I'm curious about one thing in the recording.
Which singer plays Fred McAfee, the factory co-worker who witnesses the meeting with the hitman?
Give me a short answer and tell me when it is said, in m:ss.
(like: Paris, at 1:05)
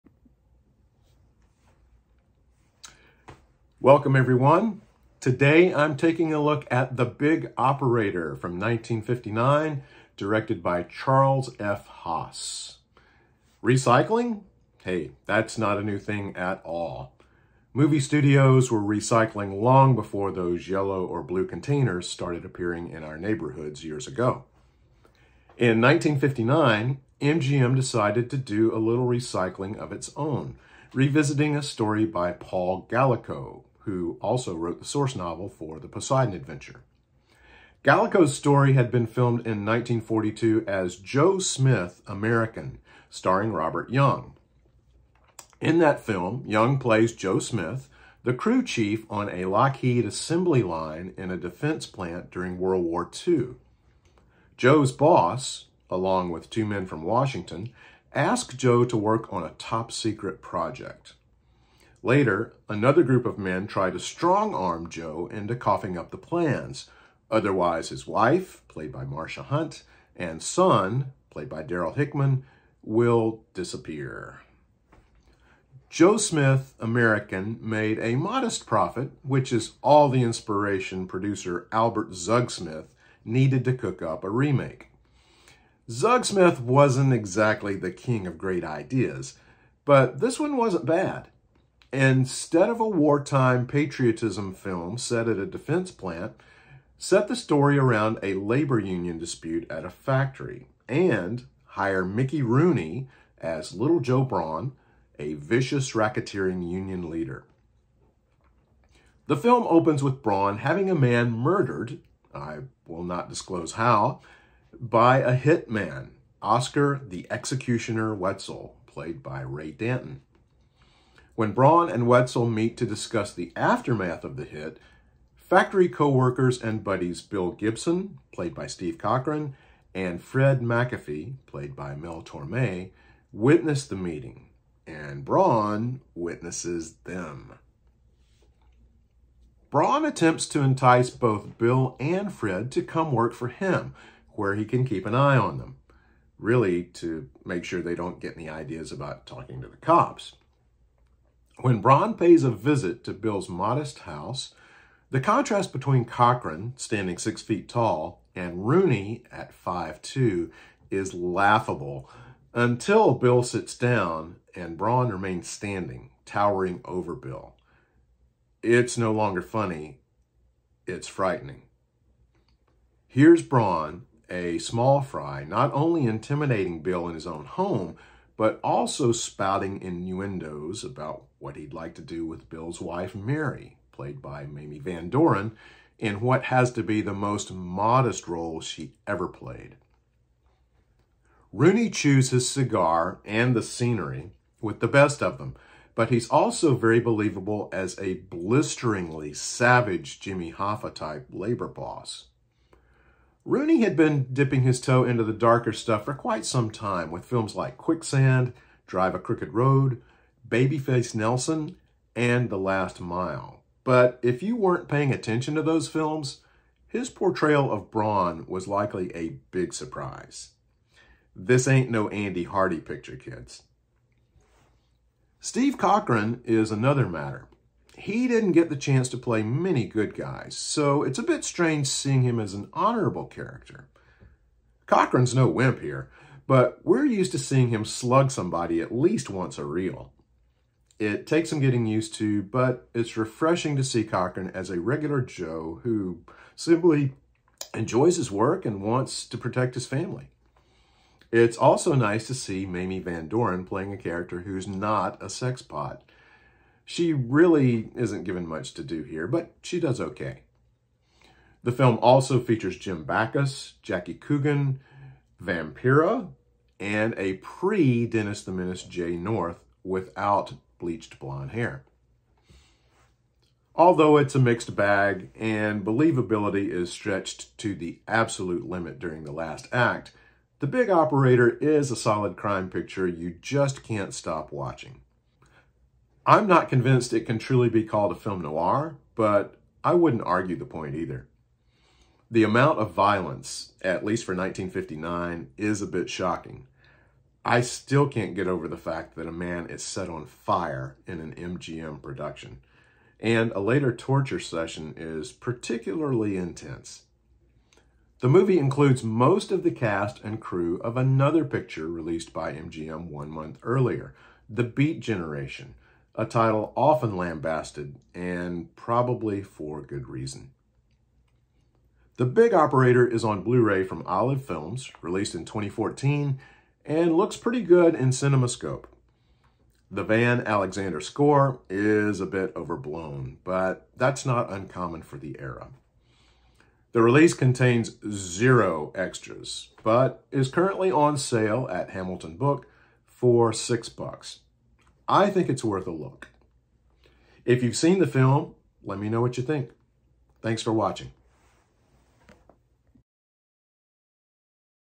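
Mel Torme, at 2:11.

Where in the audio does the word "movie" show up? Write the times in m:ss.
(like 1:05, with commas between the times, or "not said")
0:17, 5:08.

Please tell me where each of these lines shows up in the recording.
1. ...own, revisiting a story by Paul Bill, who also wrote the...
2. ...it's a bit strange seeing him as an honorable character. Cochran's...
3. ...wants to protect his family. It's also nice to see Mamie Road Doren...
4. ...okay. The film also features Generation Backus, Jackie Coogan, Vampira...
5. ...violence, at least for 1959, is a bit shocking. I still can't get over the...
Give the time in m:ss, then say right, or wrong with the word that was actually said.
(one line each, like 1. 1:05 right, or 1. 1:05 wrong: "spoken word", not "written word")
1. 0:30 wrong: "Gallico", not "Bill"
2. 3:51 right
3. 4:08 wrong: "Van", not "Road"
4. 4:20 wrong: "Jim", not "Generation"
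5. 4:52 right.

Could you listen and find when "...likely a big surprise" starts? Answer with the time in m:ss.
3:38.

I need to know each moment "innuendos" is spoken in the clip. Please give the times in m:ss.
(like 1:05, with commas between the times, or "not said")
2:59.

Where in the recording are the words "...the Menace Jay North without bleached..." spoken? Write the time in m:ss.
4:28.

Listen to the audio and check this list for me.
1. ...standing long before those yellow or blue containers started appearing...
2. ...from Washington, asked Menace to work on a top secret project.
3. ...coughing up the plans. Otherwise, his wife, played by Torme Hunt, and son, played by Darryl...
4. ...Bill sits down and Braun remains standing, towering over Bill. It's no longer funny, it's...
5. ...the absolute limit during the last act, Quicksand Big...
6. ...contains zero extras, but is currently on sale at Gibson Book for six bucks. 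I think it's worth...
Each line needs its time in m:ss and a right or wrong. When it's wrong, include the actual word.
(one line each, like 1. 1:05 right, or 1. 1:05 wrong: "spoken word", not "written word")
1. 0:18 wrong: "recycling", not "standing"
2. 0:56 wrong: "Joe", not "Menace"
3. 1:05 wrong: "Marsha", not "Torme"
4. 2:43 right
5. 4:37 wrong: "The", not "Quicksand"
6. 5:37 wrong: "Hamilton", not "Gibson".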